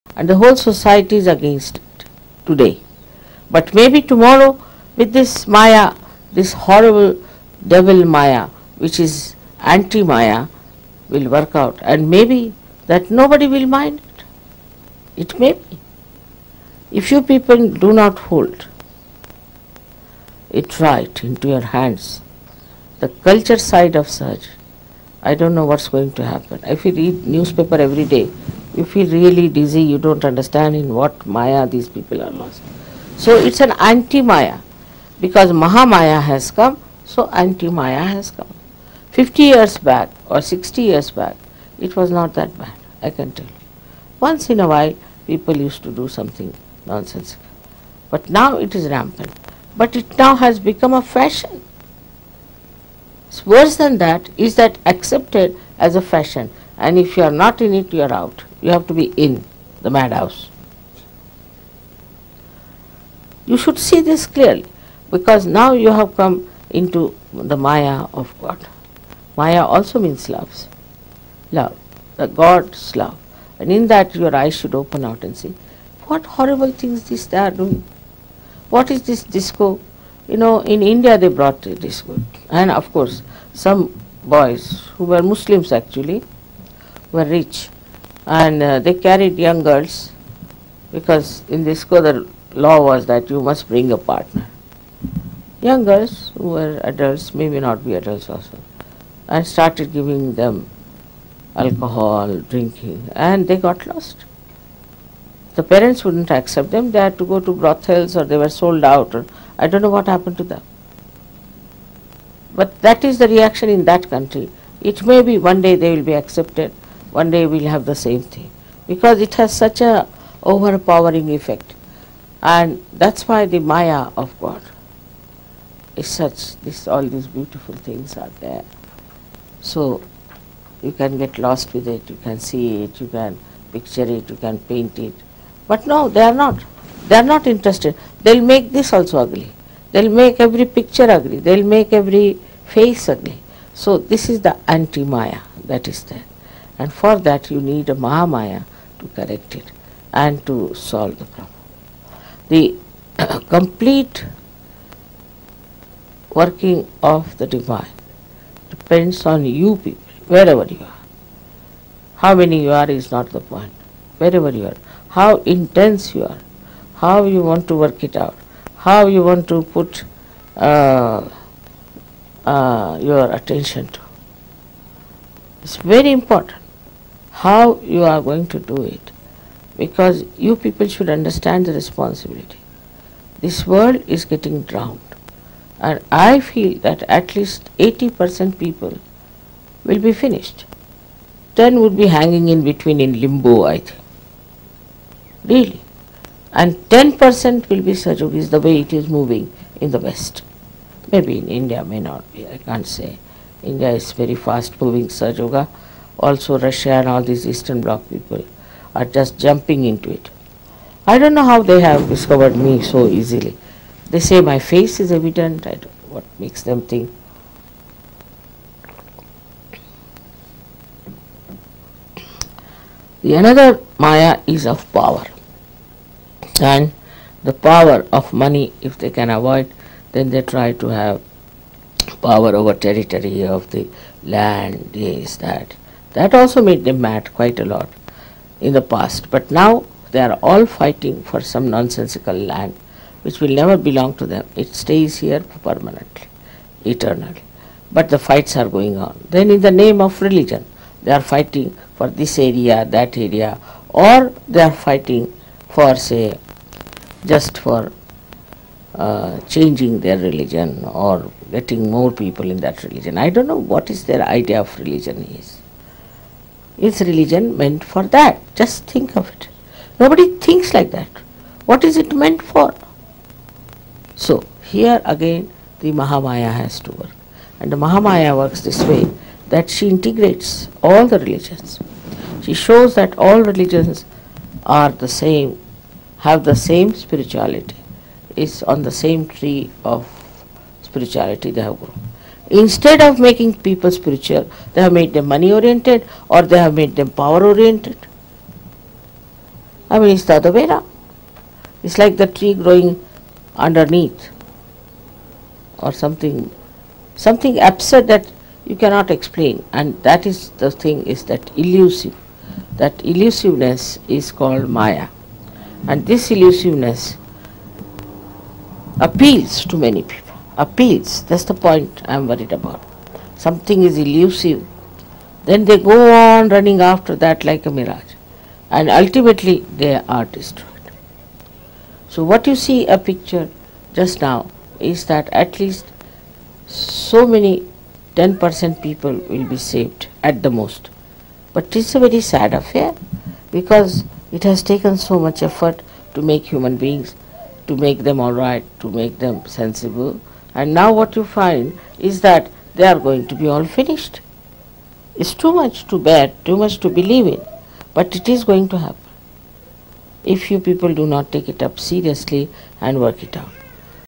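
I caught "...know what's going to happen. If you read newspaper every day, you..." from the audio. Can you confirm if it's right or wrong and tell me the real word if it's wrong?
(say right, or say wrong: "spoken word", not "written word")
right.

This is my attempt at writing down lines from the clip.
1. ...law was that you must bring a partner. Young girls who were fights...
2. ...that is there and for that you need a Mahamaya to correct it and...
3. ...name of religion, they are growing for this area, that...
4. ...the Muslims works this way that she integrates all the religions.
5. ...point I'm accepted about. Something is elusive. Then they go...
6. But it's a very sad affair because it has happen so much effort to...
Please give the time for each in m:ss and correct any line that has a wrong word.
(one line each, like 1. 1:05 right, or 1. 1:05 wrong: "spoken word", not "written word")
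1. 1:32 wrong: "adults", not "fights"
2. 2:25 right
3. 4:09 wrong: "fighting", not "growing"
4. 4:37 wrong: "Mahamaya", not "Muslims"
5. 5:21 wrong: "worried", not "accepted"
6. 5:41 wrong: "taken", not "happen".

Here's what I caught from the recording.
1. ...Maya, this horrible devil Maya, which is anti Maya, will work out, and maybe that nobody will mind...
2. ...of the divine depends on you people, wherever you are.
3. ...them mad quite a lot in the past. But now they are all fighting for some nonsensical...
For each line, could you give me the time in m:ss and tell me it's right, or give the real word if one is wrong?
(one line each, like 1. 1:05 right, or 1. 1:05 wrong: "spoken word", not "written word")
1. 0:05 right
2. 2:37 right
3. 3:56 right.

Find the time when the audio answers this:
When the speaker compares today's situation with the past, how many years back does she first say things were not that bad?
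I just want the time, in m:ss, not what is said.
0:39.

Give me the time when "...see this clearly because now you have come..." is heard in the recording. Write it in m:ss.
1:03.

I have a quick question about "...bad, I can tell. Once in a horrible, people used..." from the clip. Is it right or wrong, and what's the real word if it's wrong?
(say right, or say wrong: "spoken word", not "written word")
wrong: "while", not "horrible".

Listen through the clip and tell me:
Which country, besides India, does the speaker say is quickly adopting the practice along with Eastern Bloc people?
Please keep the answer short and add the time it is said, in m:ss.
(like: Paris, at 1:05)
Russia, at 3:26.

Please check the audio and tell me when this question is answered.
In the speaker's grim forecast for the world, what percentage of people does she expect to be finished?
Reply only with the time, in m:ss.
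3:07.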